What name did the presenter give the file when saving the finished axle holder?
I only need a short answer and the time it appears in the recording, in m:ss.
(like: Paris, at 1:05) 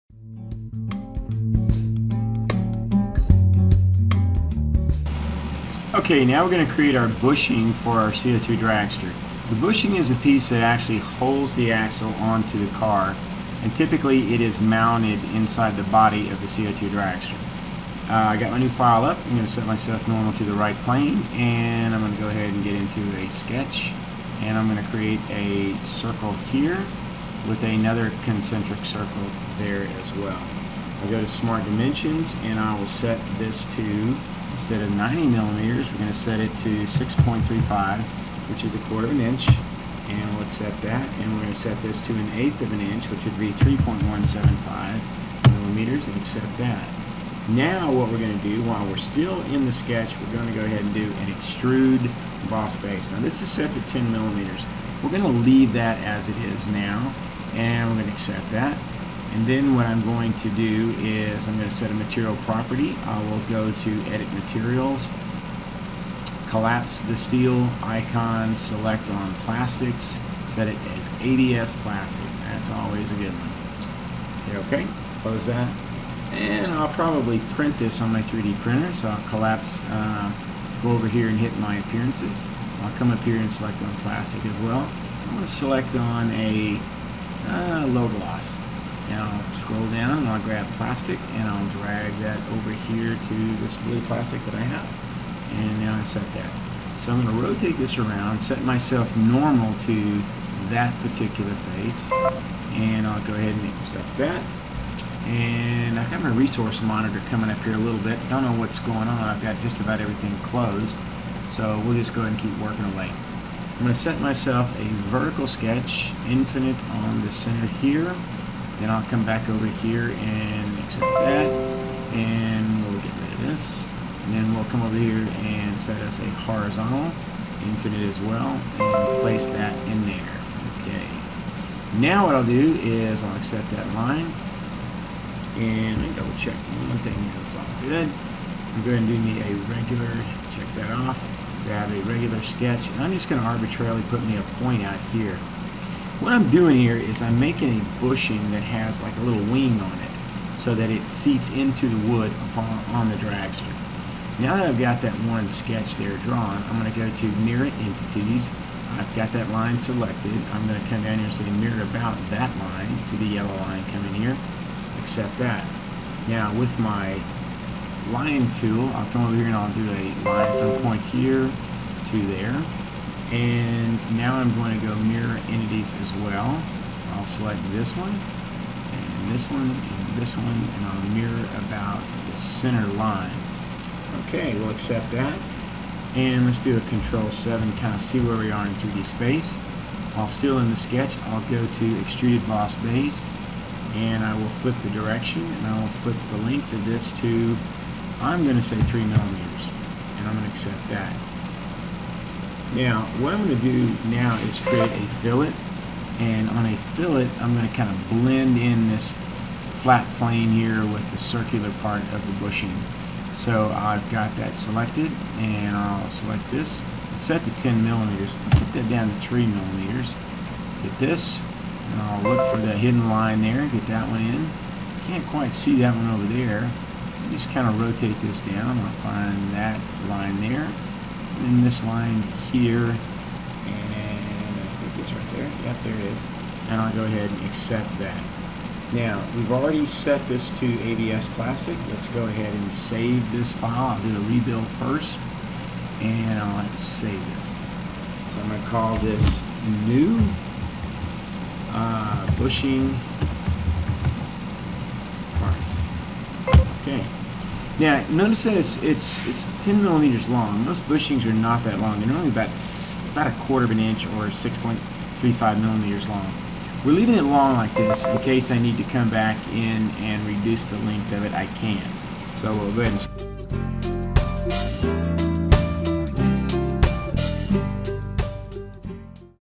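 bushing parts, at 4:12.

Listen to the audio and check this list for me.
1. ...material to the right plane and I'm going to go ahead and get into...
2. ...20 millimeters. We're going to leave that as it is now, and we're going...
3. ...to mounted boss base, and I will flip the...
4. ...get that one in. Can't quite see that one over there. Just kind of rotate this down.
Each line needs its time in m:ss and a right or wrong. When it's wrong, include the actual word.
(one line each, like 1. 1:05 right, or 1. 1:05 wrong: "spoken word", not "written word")
1. 0:20 wrong: "normal", not "material"
2. 0:53 wrong: "10", not "20"
3. 3:11 wrong: "extruded", not "mounted"
4. 3:43 right.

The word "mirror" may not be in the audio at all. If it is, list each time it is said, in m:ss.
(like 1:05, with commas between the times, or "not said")
2:37, 2:41, 2:54, 3:01.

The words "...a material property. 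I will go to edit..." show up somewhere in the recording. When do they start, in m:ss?
1:01.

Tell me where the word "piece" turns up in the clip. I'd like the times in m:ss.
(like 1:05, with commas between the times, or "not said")
0:10.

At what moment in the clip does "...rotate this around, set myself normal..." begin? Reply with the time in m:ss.
1:37.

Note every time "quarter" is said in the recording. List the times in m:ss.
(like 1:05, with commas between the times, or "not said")
0:38, 4:23.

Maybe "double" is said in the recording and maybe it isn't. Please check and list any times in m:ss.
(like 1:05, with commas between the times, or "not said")
2:16.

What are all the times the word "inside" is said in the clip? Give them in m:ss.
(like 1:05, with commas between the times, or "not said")
0:15.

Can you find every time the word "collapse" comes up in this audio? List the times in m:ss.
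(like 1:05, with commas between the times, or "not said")
1:06, 1:19.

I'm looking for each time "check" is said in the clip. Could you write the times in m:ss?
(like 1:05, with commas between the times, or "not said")
2:16, 2:20.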